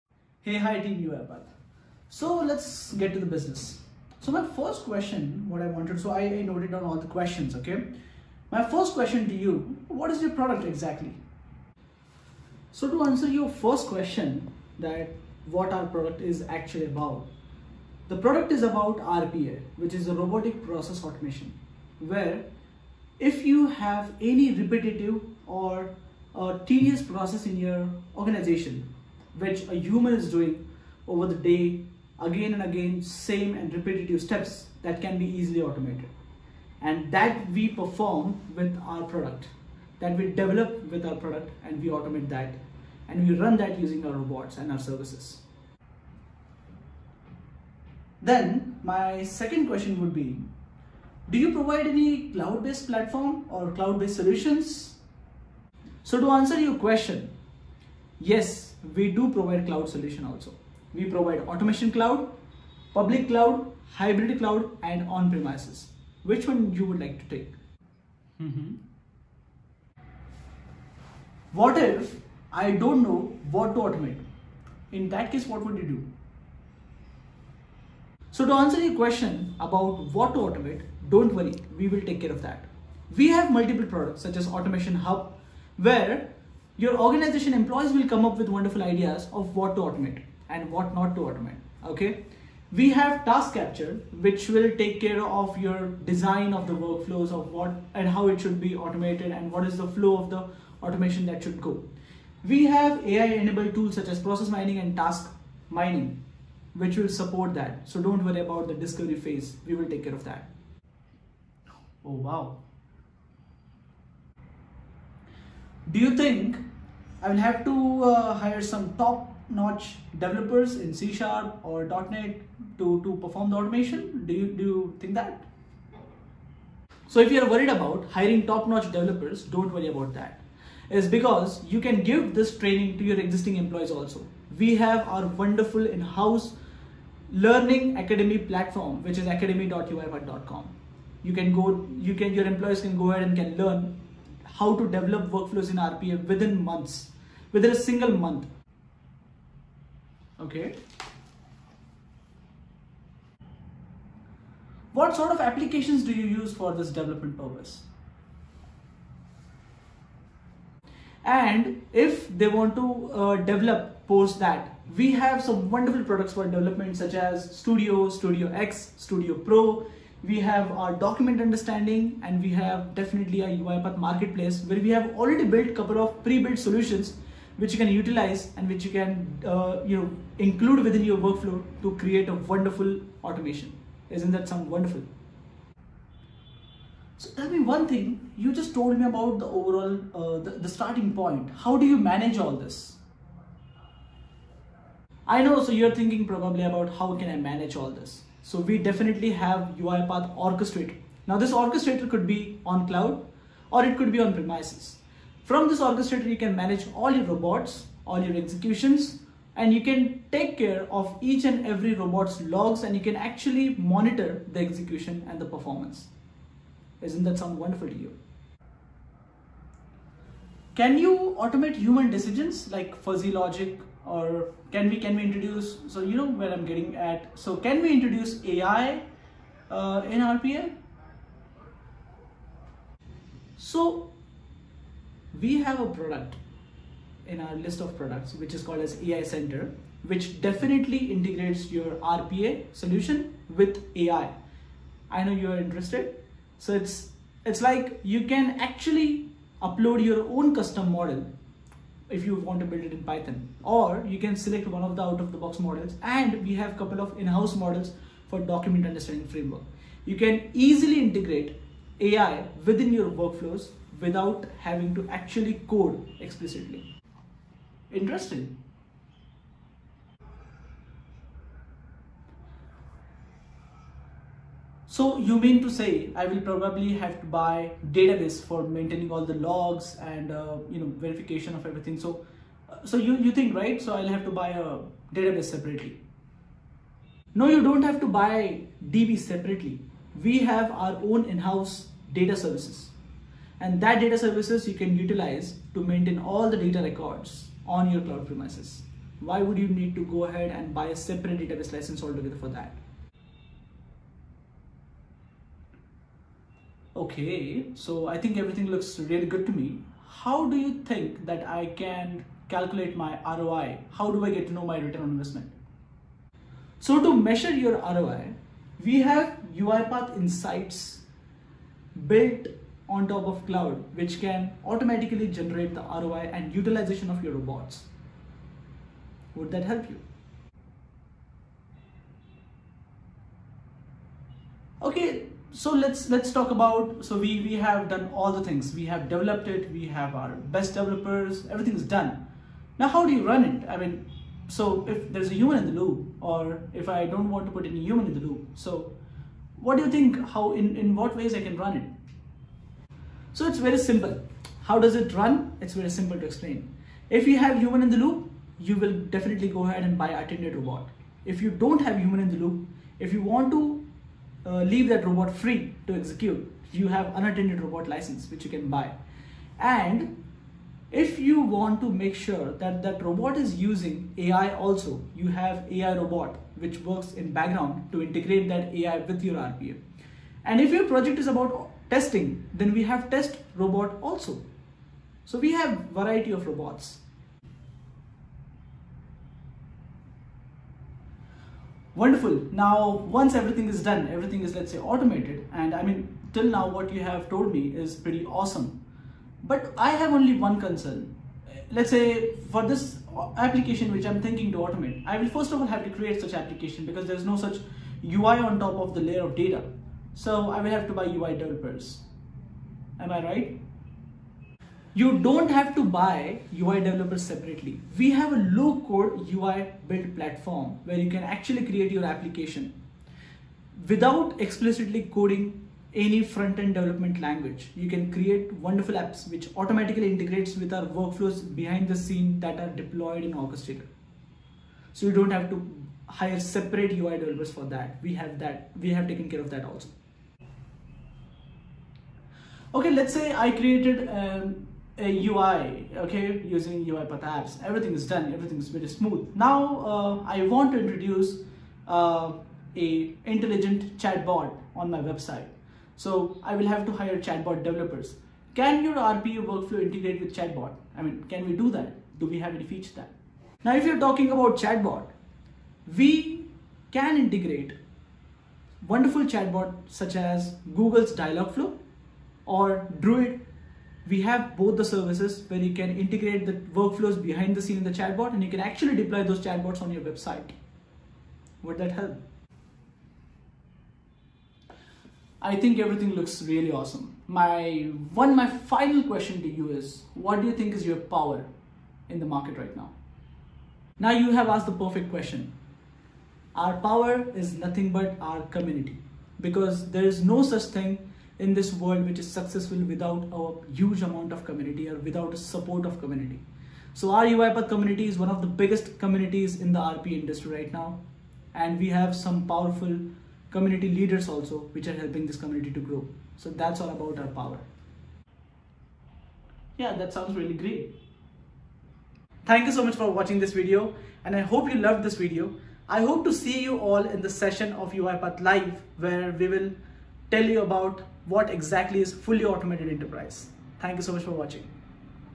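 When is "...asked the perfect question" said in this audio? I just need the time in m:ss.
8:14.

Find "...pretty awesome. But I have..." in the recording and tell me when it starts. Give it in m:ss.
6:37.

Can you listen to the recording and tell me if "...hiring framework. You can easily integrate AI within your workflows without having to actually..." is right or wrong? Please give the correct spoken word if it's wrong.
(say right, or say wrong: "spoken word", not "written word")
wrong: "understanding", not "hiring".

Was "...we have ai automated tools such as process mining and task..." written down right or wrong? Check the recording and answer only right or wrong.
wrong.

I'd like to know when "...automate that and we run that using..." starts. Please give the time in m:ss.
0:41.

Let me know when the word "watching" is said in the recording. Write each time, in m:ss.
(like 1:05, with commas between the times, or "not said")
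8:43, 8:54.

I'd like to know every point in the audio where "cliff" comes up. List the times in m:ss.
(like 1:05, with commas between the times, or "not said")
not said.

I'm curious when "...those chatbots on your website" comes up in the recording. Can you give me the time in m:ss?
7:59.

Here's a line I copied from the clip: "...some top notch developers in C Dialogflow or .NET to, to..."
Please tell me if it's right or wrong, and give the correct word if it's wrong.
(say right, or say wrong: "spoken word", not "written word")
wrong: "Sharp", not "Dialogflow".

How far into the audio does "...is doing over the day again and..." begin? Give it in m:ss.
0:30.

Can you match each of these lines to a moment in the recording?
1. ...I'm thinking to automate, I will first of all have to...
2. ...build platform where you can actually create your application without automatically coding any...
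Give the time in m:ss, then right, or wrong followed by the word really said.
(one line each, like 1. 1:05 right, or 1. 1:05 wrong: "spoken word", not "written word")
1. 6:44 right
2. 6:59 wrong: "explicitly", not "automatically".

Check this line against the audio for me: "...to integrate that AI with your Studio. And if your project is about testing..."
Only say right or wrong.
wrong.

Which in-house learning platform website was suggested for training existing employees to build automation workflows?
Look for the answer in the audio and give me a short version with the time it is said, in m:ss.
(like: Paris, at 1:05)
academy.uipath.com, at 2:19.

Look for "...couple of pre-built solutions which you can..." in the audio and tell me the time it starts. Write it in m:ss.
2:55.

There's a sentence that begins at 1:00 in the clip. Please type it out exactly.
We provide automation cloud, public cloud, hybrid cloud and on-premises.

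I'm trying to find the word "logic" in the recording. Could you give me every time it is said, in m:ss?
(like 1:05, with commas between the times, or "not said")
3:43.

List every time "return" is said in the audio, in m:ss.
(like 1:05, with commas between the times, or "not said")
5:14.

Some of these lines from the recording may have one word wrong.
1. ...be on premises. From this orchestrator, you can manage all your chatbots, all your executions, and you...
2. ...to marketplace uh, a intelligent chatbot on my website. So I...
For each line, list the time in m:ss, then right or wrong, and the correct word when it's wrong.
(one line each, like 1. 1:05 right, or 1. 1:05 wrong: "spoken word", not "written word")
1. 3:24 wrong: "robots", not "chatbots"
2. 7:30 wrong: "introduce", not "marketplace".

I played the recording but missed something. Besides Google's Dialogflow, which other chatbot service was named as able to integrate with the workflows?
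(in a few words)
Druid.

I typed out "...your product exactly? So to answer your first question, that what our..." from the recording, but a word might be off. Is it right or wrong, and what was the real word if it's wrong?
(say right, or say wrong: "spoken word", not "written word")
right.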